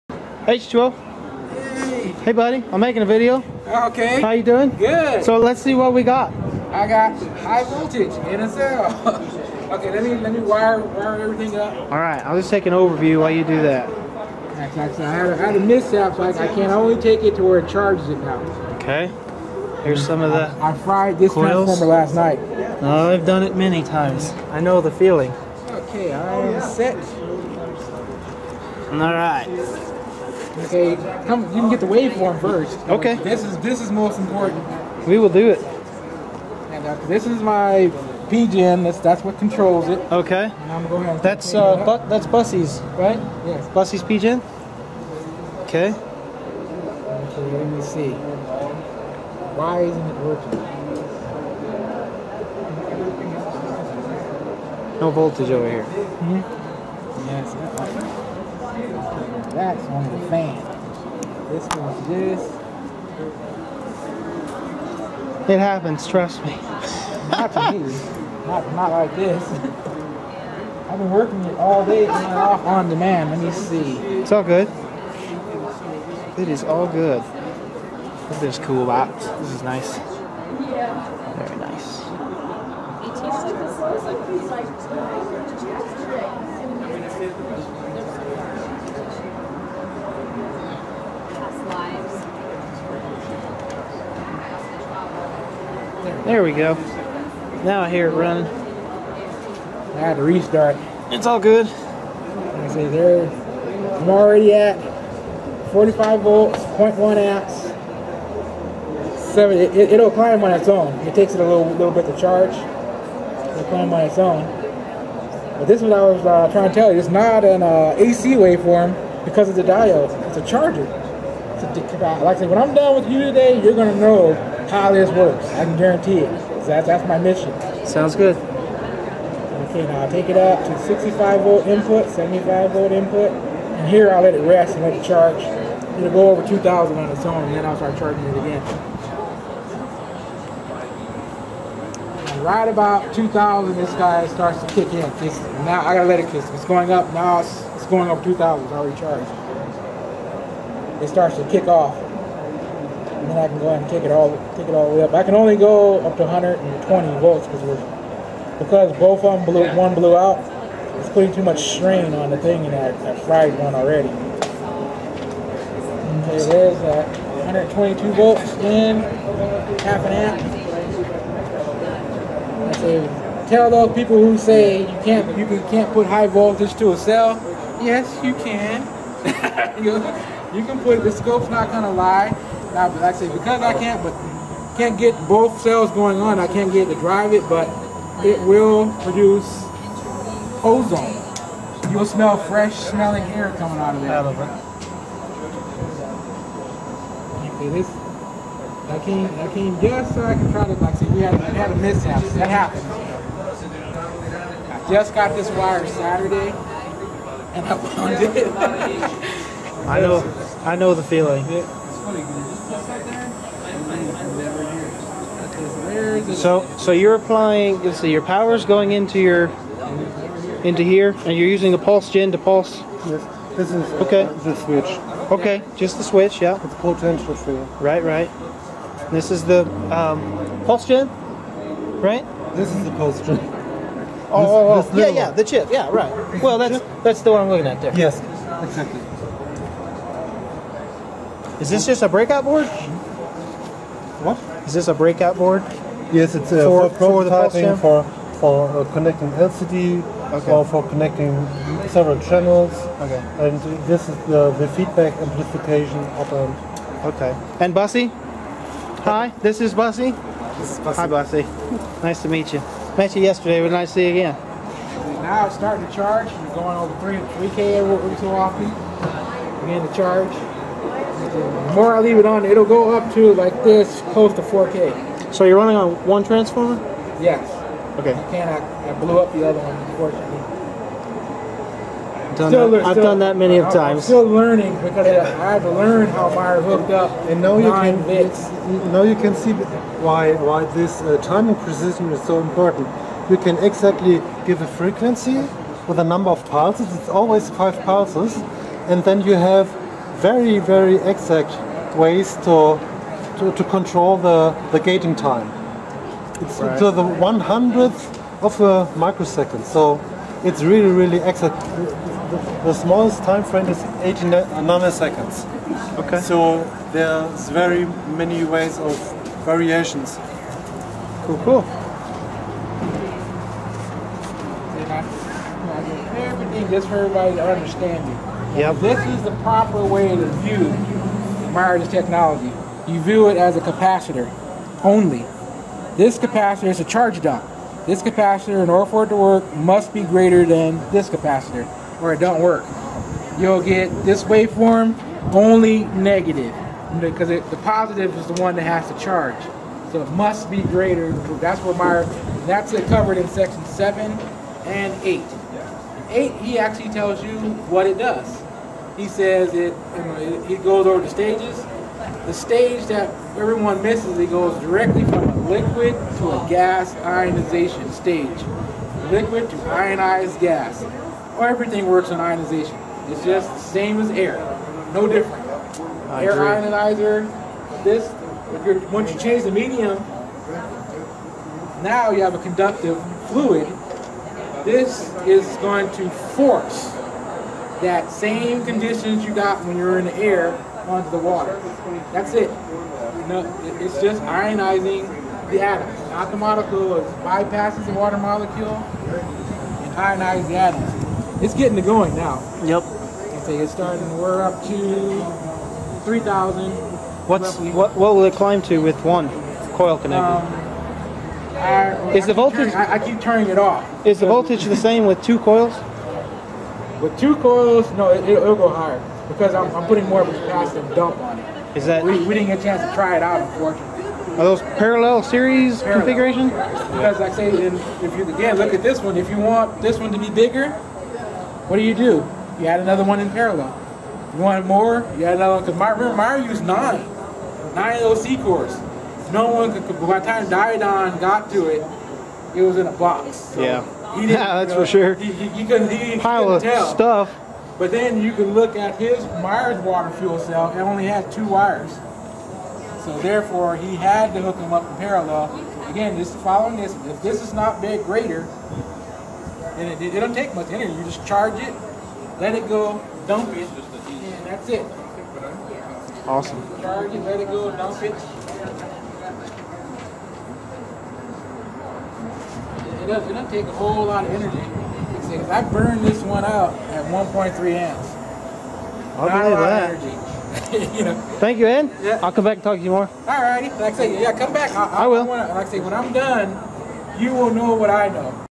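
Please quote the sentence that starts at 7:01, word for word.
Is that we, we didn't get a chance to try it out, unfortunately.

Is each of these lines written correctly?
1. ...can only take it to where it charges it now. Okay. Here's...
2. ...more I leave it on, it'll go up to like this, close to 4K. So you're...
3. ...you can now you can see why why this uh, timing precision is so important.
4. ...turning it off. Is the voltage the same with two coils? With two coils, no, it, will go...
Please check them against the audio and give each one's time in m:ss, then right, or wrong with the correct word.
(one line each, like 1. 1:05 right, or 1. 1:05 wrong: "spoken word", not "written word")
1. 0:16 right
2. 4:31 right
3. 4:47 right
4. 6:53 right.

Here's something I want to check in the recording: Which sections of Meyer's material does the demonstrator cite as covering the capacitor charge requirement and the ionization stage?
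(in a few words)
Sections 7 and 8.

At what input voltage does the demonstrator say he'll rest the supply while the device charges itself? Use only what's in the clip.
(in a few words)
75 volts.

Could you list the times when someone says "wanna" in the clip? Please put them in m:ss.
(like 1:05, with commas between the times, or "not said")
8:05.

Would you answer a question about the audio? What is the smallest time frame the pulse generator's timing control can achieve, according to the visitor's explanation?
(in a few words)
18 nanoseconds.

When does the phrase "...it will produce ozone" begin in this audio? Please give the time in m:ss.
3:08.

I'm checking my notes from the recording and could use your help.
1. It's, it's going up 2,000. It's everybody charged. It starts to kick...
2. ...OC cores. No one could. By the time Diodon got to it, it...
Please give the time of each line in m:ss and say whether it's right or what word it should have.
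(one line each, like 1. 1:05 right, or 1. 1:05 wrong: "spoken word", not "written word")
1. 2:27 wrong: "already", not "everybody"
2. 7:18 right.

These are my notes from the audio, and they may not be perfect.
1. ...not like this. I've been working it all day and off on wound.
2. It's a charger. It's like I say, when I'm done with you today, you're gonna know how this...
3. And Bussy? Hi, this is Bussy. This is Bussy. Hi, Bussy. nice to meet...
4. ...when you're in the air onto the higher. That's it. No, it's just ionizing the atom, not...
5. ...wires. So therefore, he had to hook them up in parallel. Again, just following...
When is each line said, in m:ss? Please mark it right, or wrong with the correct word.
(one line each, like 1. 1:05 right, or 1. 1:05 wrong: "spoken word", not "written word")
1. 1:08 wrong: "demand", not "wound"
2. 2:00 right
3. 4:17 right
4. 6:29 wrong: "water", not "higher"
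5. 7:31 right.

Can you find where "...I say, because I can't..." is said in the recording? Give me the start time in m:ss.
3:03.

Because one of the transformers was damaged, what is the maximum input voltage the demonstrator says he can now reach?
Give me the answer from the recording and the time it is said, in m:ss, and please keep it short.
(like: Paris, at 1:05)
120 volts, at 2:36.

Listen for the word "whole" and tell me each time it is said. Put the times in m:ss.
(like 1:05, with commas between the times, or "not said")
7:53.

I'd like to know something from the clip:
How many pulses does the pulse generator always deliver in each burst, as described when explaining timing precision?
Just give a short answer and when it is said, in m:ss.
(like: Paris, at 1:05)
5, at 4:57.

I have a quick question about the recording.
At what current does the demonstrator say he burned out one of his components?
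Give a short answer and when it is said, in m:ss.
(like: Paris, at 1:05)
1.3 amps, at 7:57.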